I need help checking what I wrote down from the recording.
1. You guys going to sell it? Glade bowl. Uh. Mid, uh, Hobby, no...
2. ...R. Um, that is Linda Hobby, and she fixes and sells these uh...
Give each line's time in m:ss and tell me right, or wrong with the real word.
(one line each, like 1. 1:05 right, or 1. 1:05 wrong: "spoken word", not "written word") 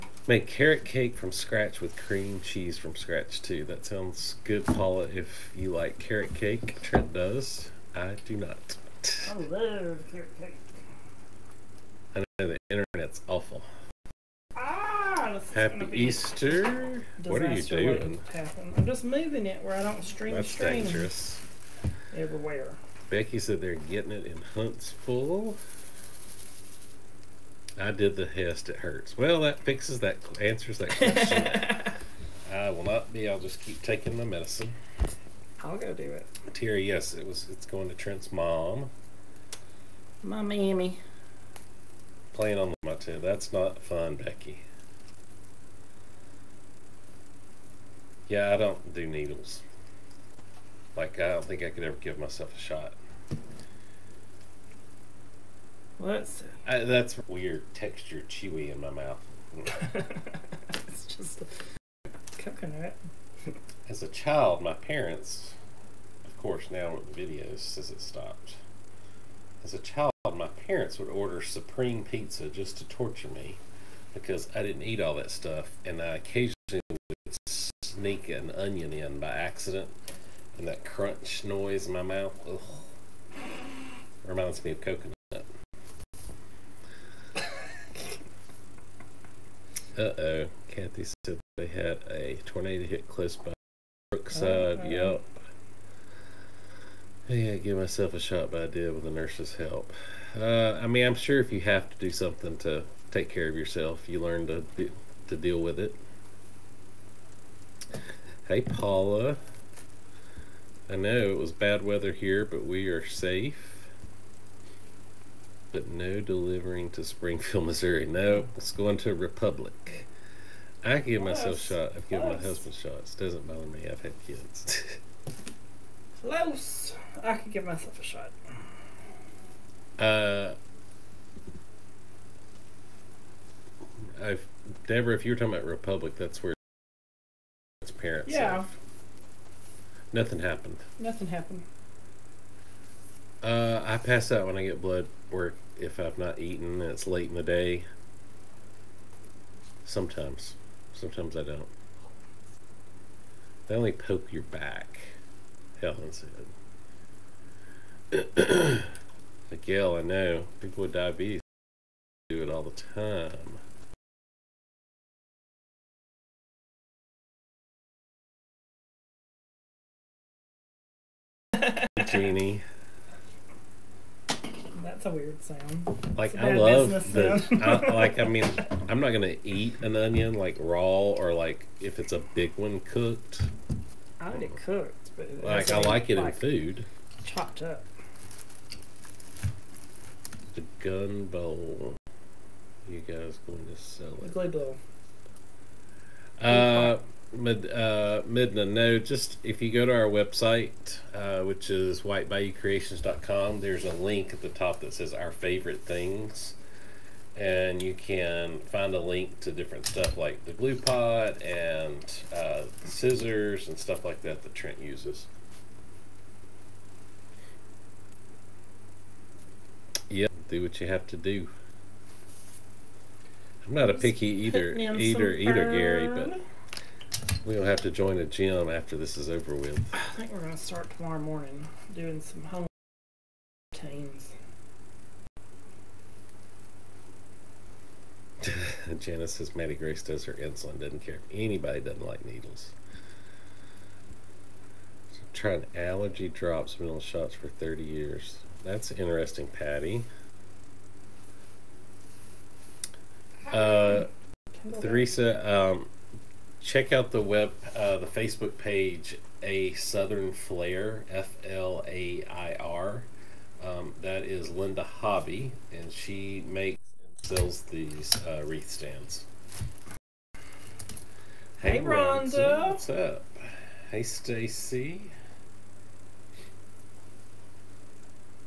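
1. 3:12 wrong: "Midna", not "Hobby"
2. 4:22 wrong: "makes", not "fixes".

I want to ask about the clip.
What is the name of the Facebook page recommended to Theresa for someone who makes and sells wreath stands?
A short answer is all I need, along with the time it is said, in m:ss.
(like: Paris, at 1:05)
A Southern Flair, at 4:19.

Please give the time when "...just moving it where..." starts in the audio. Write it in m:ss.
0:18.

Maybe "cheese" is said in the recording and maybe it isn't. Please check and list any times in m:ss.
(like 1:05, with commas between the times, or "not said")
0:02.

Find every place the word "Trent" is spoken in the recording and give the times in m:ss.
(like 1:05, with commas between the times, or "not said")
0:06, 0:37, 3:34.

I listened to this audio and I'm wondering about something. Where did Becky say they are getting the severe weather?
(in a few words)
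Huntsville.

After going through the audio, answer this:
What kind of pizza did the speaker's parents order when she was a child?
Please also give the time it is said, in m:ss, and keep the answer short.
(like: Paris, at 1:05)
Supreme, at 1:11.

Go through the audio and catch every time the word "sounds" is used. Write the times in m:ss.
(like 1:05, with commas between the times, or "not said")
0:03, 2:55.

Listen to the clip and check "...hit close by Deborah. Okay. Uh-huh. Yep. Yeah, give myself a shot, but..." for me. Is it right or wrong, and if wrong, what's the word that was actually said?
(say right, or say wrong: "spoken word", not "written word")
wrong: "Brookside", not "Deborah".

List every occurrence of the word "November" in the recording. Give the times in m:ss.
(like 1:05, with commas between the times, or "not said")
not said.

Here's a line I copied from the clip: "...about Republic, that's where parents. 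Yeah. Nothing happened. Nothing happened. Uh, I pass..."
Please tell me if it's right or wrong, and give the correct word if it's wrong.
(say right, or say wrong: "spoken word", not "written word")
right.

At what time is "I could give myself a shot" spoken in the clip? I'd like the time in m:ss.
2:07.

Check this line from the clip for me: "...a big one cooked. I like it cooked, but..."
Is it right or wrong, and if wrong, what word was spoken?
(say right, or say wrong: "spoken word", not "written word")
right.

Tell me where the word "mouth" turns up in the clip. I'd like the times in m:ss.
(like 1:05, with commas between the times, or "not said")
0:58, 1:22.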